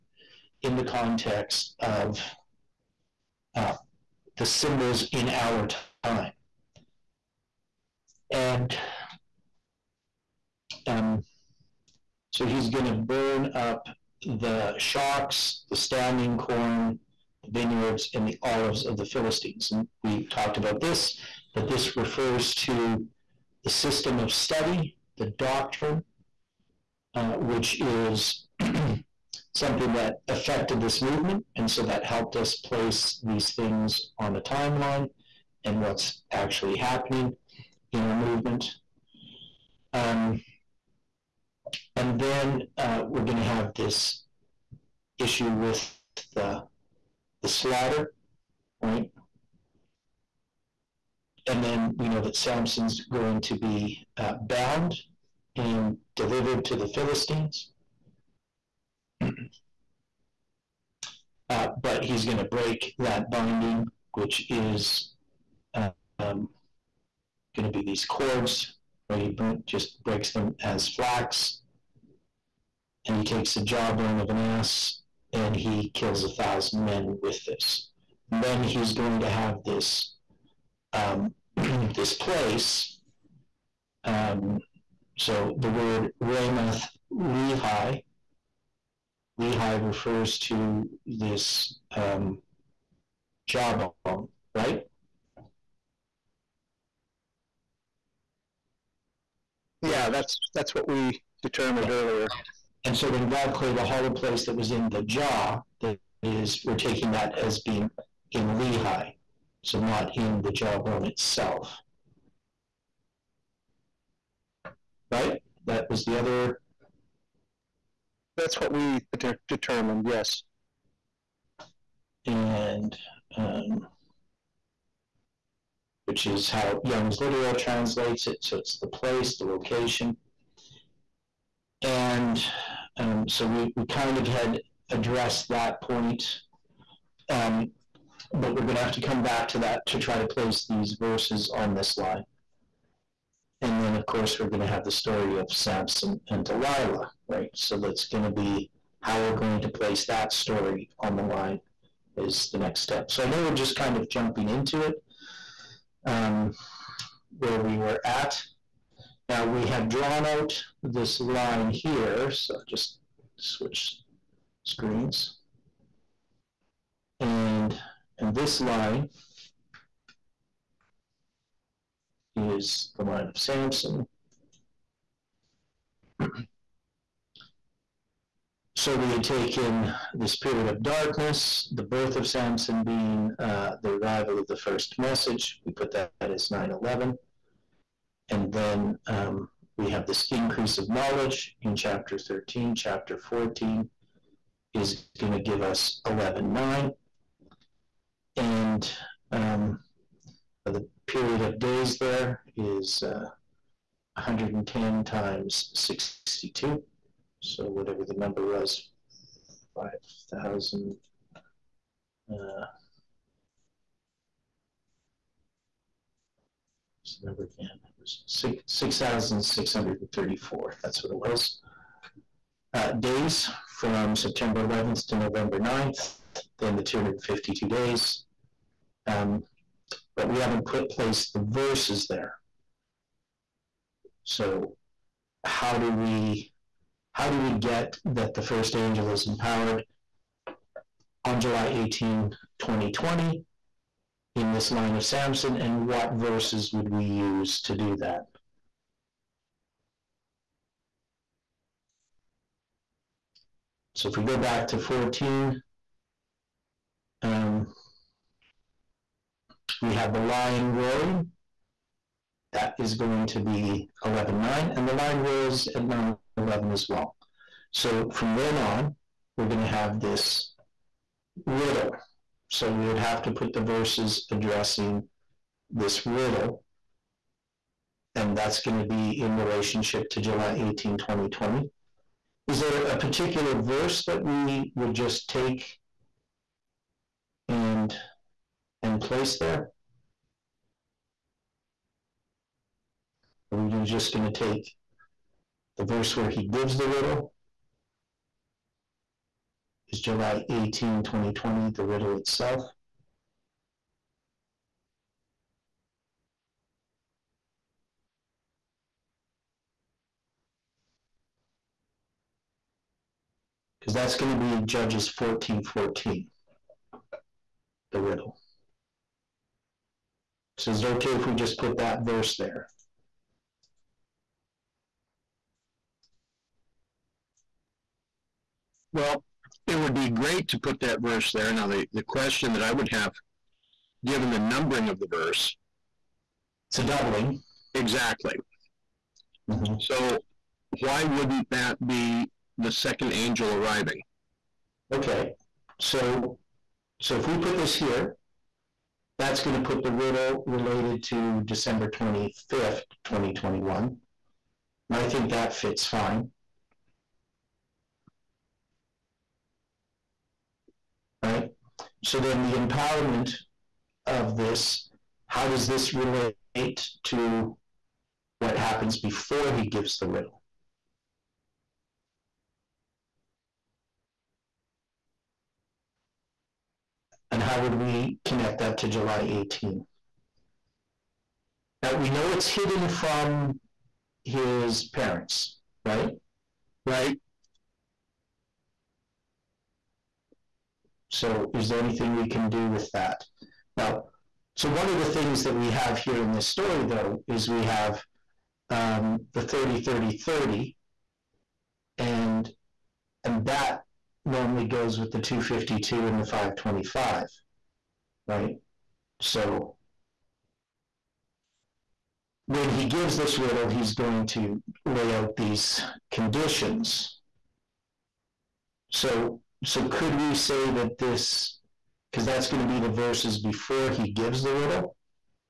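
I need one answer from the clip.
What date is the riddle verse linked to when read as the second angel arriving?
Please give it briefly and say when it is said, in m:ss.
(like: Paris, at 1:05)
December 25th, 2021, at 5:51.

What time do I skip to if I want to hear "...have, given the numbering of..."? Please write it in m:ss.
5:32.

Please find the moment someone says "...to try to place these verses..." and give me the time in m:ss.
2:19.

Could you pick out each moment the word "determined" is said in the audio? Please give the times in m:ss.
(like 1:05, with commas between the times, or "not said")
1:41, 1:59.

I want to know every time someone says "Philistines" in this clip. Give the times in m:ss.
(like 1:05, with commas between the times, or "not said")
0:19, 0:56.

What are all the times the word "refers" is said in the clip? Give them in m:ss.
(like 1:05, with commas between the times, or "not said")
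0:21, 1:29.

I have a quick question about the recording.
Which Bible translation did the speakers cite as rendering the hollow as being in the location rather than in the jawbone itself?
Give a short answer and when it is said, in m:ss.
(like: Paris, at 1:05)
Young's Literal, at 2:06.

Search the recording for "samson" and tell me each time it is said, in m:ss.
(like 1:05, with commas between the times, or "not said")
0:52, 2:25, 2:53, 3:02, 4:05.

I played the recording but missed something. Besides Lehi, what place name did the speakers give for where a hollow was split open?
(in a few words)
Ramoth Lehi.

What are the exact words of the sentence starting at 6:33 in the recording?
Now, so one of the things that we have here in this story, though, is we have um, the 30, 30, 30.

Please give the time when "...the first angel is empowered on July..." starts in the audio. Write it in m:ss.
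3:58.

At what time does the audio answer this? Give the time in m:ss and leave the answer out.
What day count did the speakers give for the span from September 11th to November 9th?
3:38.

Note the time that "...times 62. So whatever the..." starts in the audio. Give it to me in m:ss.
3:25.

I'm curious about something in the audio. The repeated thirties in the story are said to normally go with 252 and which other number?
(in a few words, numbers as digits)
525.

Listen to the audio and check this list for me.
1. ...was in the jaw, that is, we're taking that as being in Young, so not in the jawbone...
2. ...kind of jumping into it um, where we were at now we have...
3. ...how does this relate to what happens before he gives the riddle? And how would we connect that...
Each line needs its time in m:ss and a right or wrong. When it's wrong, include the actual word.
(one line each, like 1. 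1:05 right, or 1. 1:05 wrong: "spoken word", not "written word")
1. 1:44 wrong: "Lehi", not "Young"
2. 2:33 right
3. 6:05 right.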